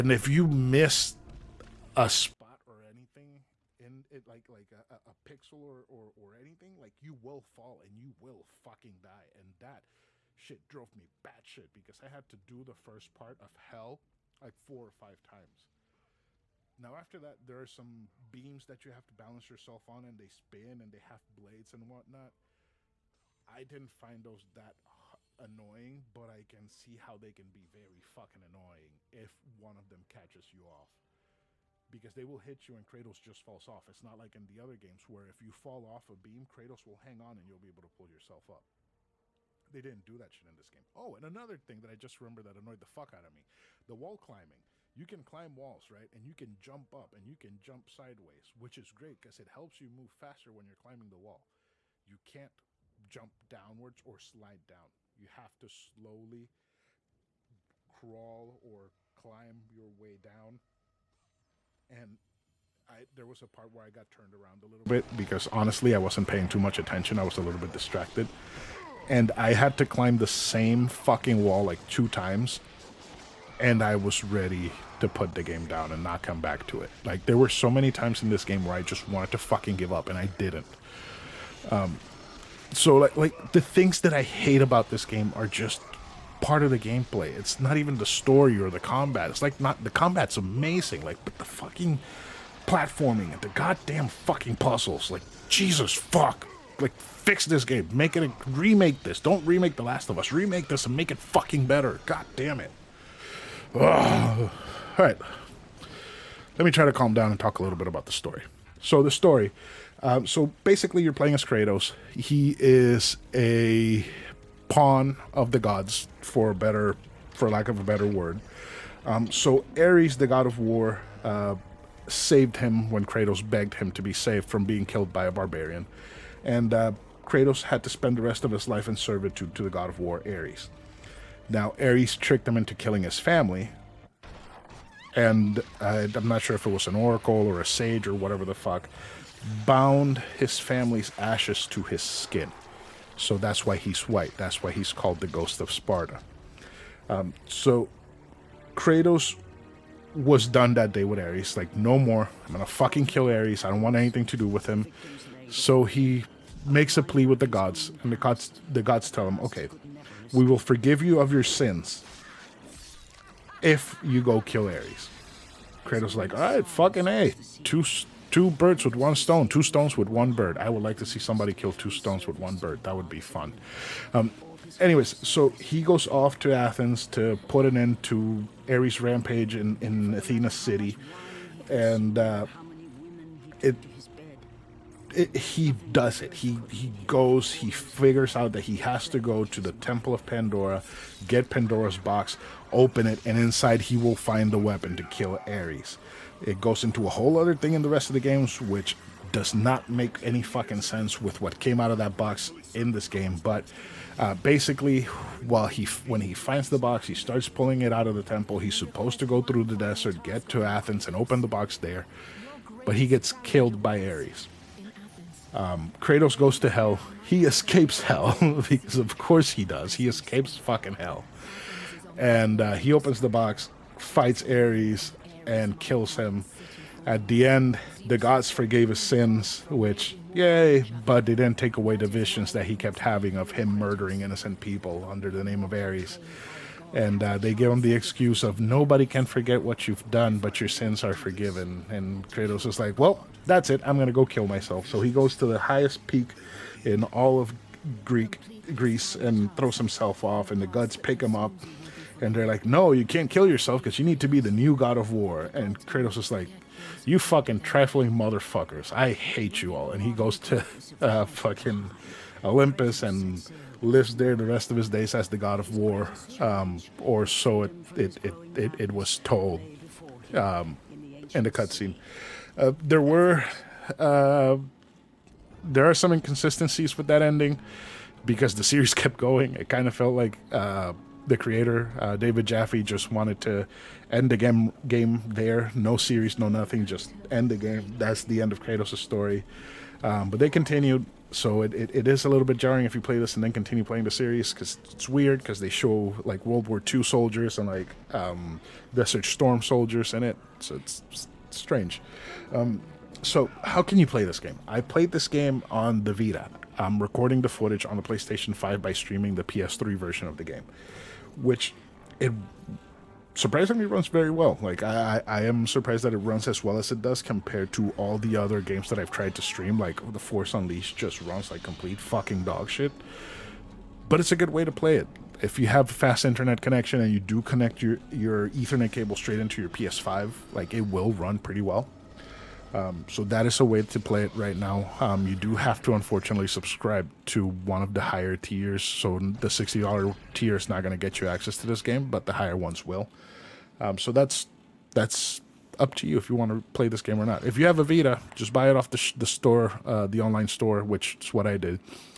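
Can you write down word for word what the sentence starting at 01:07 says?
I was a little bit distracted.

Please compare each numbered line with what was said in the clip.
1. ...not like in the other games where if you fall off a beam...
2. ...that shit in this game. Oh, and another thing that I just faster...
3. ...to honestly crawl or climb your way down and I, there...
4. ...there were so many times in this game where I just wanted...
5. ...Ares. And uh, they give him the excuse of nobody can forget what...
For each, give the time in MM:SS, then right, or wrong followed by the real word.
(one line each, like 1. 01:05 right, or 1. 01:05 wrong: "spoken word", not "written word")
1. 00:34 right
2. 00:40 wrong: "remember", not "faster"
3. 00:55 wrong: "slowly", not "honestly"
4. 01:17 right
5. 03:55 right.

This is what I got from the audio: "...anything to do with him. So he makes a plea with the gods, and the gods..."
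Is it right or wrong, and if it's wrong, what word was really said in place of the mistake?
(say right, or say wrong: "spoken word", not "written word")
right.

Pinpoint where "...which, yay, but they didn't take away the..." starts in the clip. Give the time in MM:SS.
03:49.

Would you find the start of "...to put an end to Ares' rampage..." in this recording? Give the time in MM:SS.
02:57.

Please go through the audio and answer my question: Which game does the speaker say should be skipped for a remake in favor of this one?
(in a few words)
The Last of Us.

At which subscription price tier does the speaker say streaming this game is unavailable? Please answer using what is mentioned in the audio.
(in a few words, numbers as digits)
$60.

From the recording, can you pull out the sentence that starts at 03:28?
He's supposed to go through the desert, get to Athens, and open the box there, but he gets killed by Ares.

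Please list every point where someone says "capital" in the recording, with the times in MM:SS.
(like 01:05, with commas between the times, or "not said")
not said.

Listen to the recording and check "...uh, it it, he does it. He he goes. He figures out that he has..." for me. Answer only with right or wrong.
right.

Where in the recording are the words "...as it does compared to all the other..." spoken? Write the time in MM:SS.
05:16.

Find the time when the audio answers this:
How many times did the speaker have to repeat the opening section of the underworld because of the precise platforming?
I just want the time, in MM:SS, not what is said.
00:14.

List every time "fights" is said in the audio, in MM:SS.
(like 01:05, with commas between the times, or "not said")
03:43.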